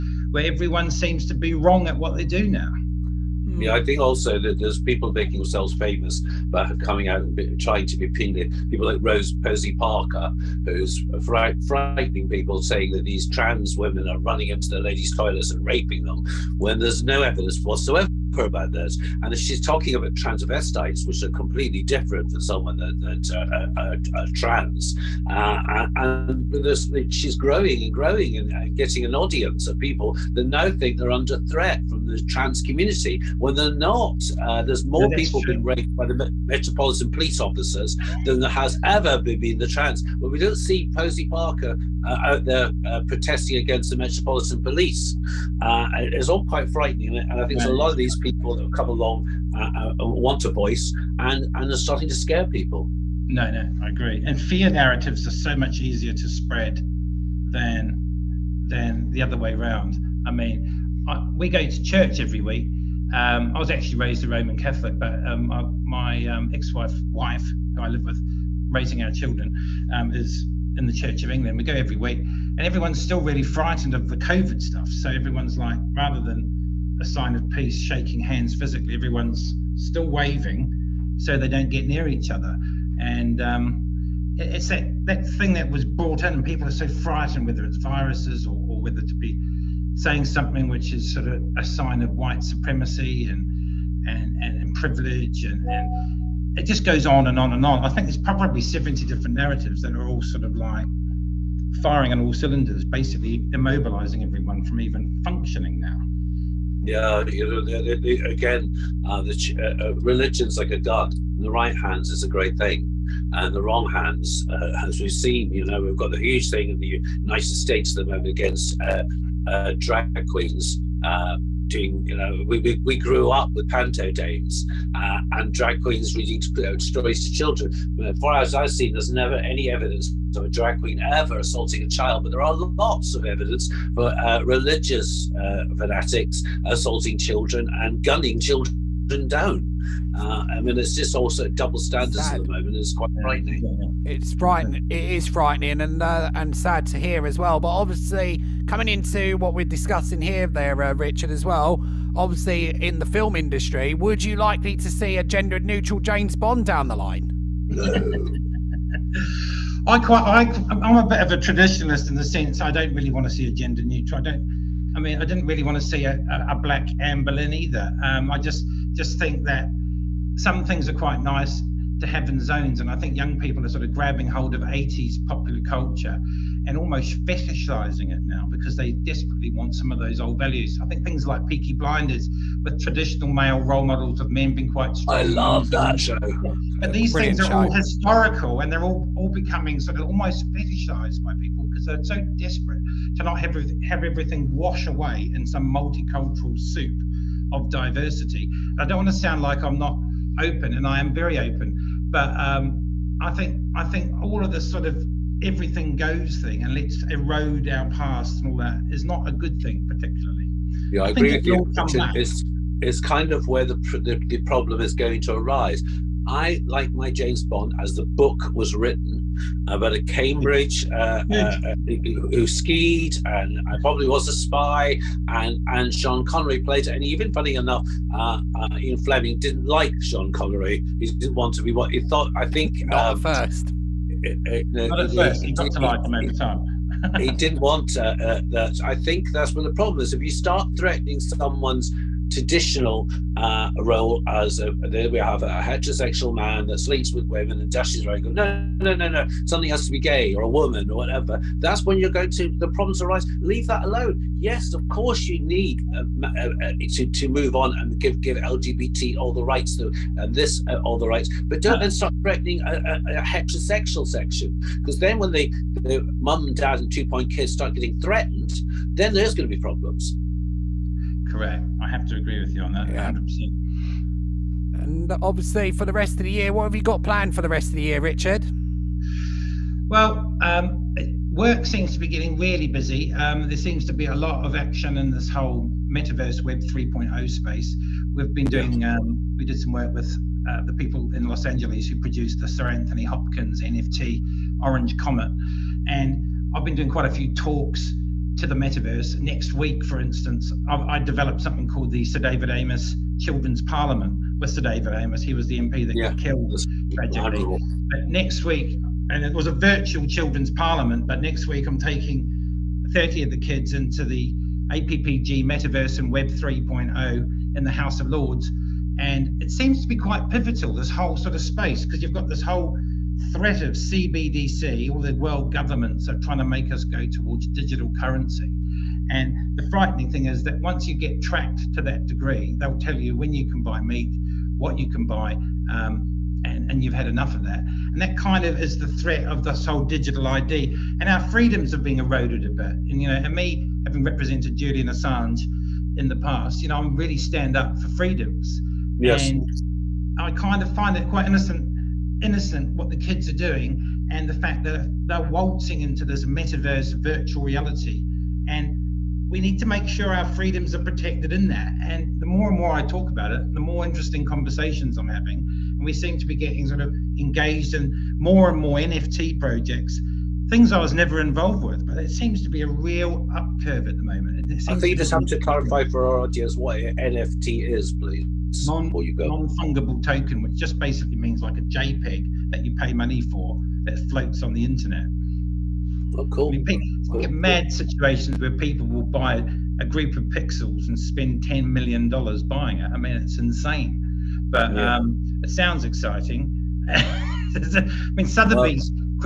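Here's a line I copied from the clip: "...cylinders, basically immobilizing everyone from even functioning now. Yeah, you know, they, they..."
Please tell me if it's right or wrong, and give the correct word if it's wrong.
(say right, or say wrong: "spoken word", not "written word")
right.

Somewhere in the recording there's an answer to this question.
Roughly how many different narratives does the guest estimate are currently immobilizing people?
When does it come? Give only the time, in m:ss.
1:38.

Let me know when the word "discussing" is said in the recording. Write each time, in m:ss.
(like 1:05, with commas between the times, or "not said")
2:29.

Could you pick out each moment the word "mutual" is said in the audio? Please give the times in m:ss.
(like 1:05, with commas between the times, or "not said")
not said.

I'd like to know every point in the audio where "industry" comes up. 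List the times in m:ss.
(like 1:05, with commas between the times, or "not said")
2:33.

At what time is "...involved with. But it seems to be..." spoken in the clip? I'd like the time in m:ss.
6:11.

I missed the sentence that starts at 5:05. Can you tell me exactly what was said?
He was the MP that yeah, got killed tragically.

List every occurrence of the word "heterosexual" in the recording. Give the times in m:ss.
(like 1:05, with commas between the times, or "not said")
4:05, 4:23.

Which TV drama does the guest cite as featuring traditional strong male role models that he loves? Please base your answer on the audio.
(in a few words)
Peaky Blinders.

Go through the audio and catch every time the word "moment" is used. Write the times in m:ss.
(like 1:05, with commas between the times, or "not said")
1:58, 2:22, 6:14.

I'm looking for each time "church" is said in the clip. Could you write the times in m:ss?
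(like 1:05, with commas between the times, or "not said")
1:01, 1:10.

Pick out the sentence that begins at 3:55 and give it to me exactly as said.
He, he got to like him every time.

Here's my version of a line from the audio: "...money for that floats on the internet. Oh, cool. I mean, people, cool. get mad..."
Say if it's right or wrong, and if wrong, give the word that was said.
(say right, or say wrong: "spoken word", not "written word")
right.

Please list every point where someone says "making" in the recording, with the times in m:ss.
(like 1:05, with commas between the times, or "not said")
0:05.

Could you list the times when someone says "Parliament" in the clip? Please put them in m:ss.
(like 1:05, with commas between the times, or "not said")
5:03, 5:10.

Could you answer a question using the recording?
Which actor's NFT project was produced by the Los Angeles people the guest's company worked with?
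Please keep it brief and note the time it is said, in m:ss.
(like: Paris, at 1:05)
Sir Anthony Hopkins, at 4:52.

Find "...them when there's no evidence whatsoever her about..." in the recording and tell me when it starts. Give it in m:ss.
0:16.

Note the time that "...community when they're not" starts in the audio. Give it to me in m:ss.
0:32.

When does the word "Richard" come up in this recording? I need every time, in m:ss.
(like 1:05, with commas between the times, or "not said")
2:30, 4:37.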